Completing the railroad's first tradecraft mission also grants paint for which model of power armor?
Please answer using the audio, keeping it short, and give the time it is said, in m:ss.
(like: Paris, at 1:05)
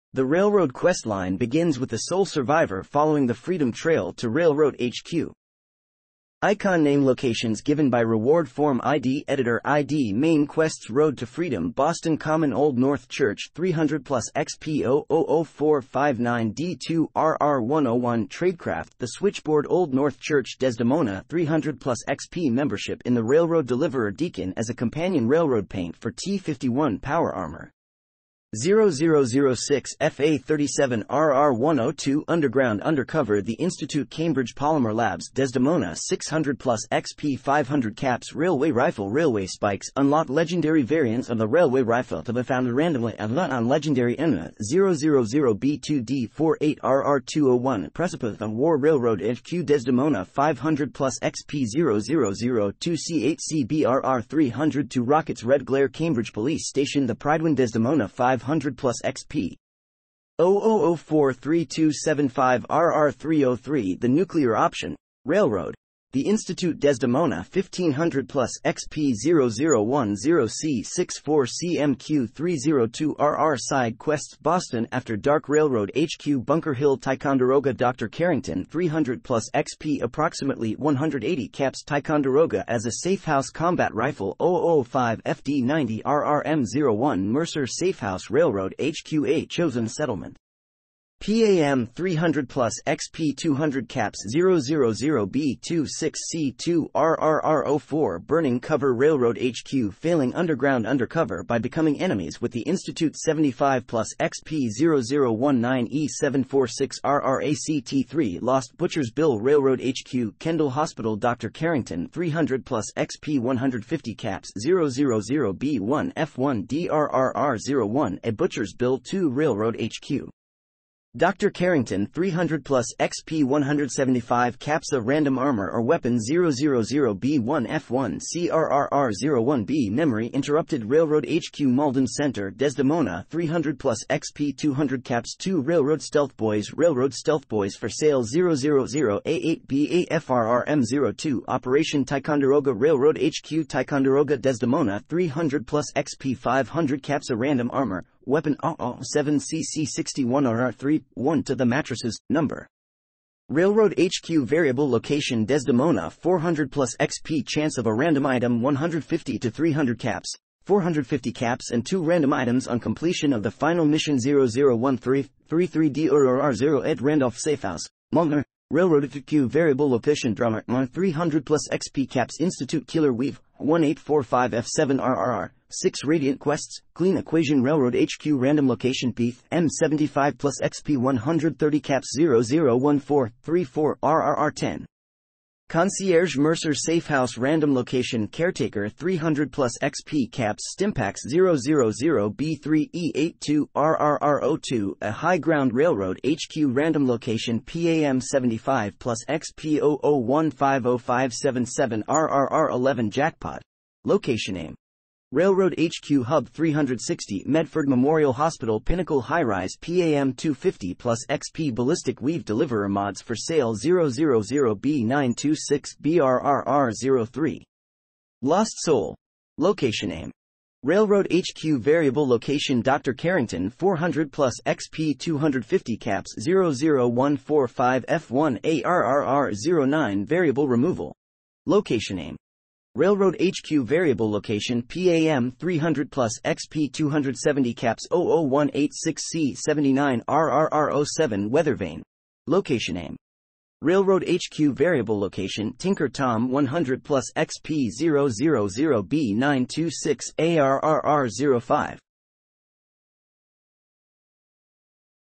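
T51, at 0:26.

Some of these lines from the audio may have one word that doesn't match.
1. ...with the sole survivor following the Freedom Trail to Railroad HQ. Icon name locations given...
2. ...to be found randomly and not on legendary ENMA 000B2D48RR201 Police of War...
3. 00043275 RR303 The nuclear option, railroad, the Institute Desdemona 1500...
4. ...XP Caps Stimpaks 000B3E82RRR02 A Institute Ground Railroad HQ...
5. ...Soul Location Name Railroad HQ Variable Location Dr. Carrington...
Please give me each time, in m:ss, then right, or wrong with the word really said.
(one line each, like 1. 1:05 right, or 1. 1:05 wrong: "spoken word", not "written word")
1. 0:01 right
2. 0:42 wrong: "Precipice", not "Police"
3. 1:00 right
4. 3:09 wrong: "High", not "Institute"
5. 3:38 right.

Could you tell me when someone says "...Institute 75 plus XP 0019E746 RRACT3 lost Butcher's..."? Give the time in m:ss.
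1:42.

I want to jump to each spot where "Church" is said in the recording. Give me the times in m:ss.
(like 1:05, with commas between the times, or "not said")
0:13, 0:20.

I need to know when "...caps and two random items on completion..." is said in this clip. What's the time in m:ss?
2:41.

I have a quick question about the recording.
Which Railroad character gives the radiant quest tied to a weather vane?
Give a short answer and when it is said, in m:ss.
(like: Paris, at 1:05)
Tinker Tom, at 4:05.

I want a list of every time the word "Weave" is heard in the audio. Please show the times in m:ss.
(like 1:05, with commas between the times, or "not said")
2:53, 3:32.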